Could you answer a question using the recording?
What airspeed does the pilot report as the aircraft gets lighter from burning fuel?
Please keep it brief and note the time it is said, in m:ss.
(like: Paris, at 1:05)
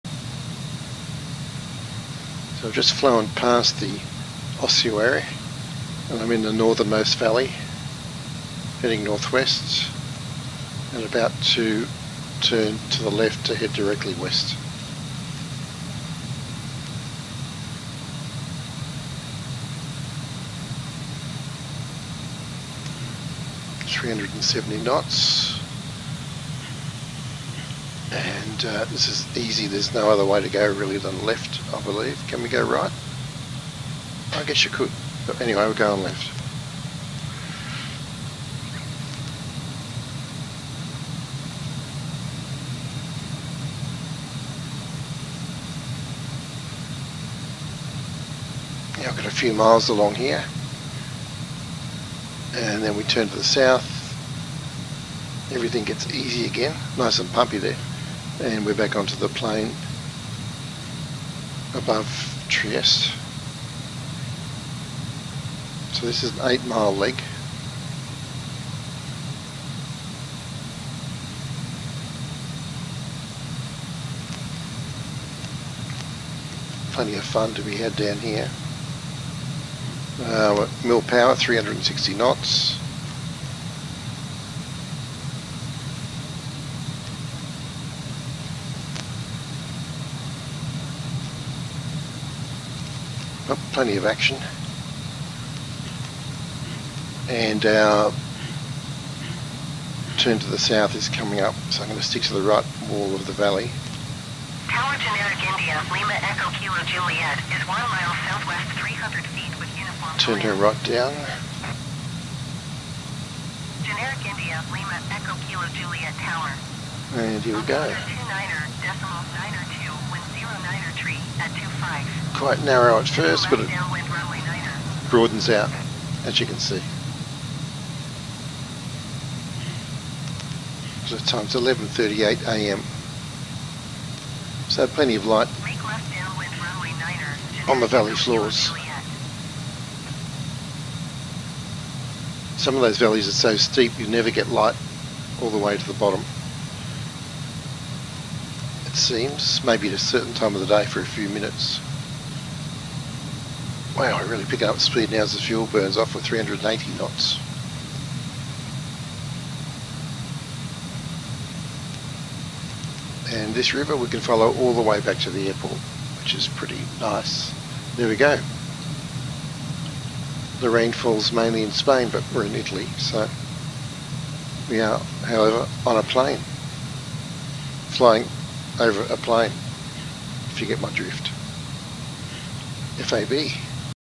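380 knots, at 2:36.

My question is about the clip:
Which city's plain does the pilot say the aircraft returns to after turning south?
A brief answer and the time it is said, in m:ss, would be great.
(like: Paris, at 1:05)
Trieste, at 1:02.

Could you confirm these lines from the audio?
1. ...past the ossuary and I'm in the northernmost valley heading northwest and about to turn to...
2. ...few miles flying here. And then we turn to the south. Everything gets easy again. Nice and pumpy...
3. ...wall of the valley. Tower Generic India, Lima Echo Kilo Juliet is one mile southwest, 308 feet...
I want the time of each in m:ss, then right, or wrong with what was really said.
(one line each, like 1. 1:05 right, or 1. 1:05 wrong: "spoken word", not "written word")
1. 0:03 right
2. 0:49 wrong: "along", not "flying"
3. 1:42 wrong: "300", not "308".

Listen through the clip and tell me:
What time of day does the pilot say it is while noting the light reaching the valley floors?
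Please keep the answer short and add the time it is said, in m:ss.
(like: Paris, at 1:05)
11:38 a.m., at 2:11.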